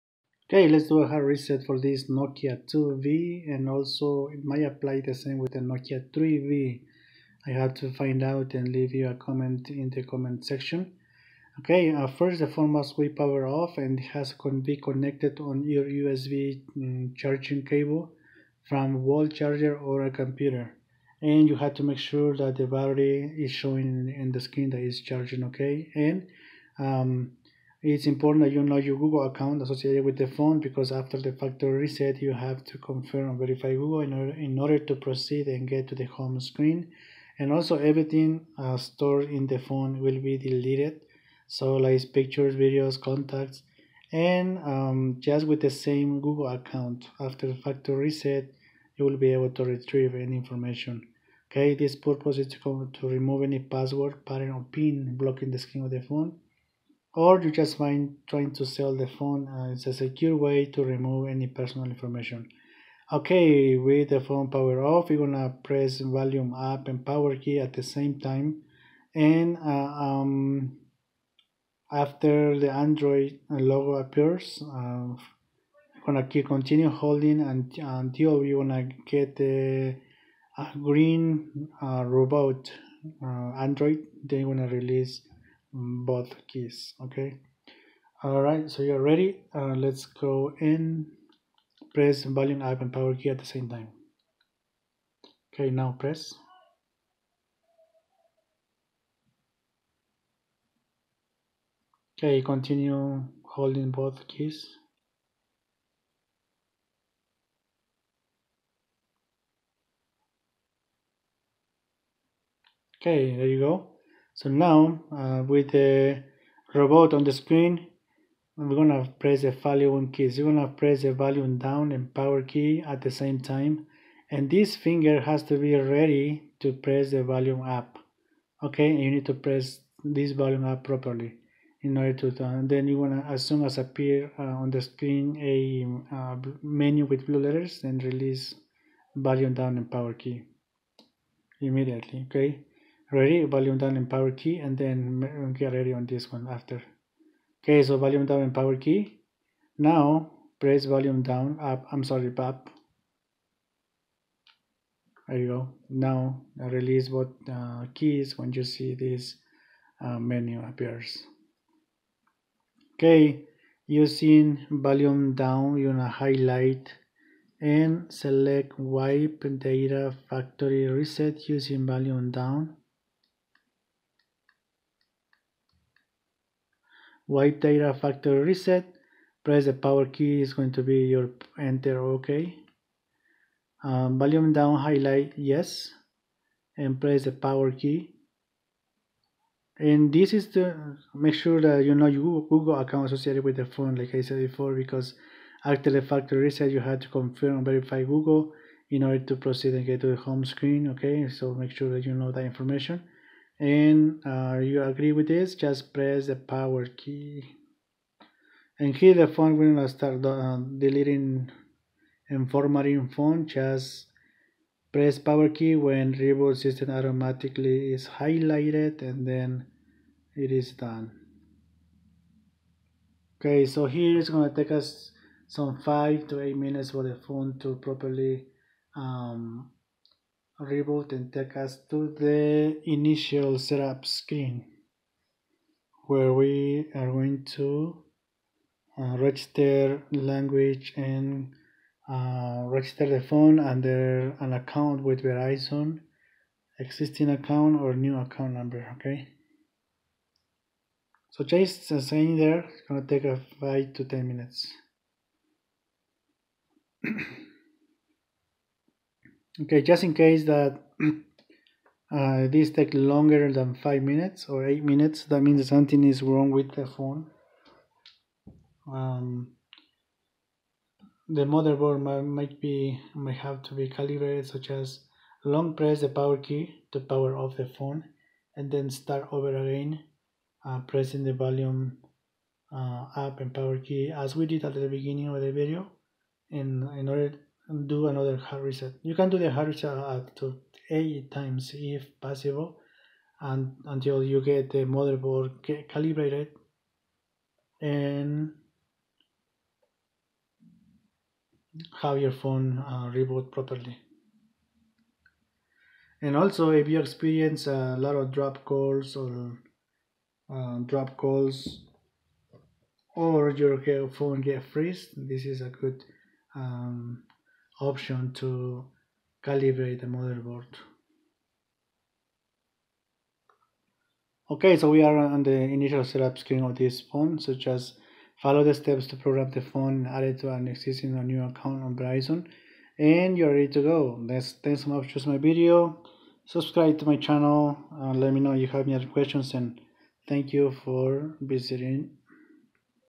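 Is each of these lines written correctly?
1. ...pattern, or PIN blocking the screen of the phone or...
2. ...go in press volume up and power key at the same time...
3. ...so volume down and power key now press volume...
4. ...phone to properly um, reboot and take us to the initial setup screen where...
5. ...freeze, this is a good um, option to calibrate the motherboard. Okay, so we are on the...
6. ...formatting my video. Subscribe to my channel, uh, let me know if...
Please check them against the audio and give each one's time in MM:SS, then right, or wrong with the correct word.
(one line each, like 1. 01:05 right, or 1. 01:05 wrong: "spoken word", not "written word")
1. 00:54 right
2. 01:30 right
3. 02:27 right
4. 03:47 right
5. 05:14 right
6. 05:35 wrong: "choosing", not "formatting".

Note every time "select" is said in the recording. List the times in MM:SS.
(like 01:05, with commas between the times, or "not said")
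02:48.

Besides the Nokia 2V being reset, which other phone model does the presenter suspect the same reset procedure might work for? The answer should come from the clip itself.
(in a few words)
Nokia 3V.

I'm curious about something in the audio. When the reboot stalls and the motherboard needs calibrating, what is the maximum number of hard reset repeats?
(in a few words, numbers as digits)
8.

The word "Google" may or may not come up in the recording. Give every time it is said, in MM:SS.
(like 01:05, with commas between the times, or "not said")
00:28, 00:33, 00:46, 03:12, 03:18.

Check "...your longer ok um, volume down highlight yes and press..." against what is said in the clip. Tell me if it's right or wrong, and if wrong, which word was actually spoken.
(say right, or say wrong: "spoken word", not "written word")
wrong: "enter", not "longer".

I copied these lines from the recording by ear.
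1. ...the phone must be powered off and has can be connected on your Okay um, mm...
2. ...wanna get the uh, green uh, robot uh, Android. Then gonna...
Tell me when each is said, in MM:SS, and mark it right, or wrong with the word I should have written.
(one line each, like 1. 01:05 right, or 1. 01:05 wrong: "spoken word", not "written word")
1. 00:12 wrong: "USB", not "Okay"
2. 01:18 right.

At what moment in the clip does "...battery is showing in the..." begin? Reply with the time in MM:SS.
00:22.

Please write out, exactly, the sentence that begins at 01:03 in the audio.
Okay, with the phone power off, you're gonna press volume up and power key at the same time.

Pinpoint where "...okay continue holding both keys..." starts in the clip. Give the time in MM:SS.
01:42.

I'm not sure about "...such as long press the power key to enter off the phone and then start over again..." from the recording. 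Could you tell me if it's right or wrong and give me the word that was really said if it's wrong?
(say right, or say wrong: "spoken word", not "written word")
wrong: "power", not "enter".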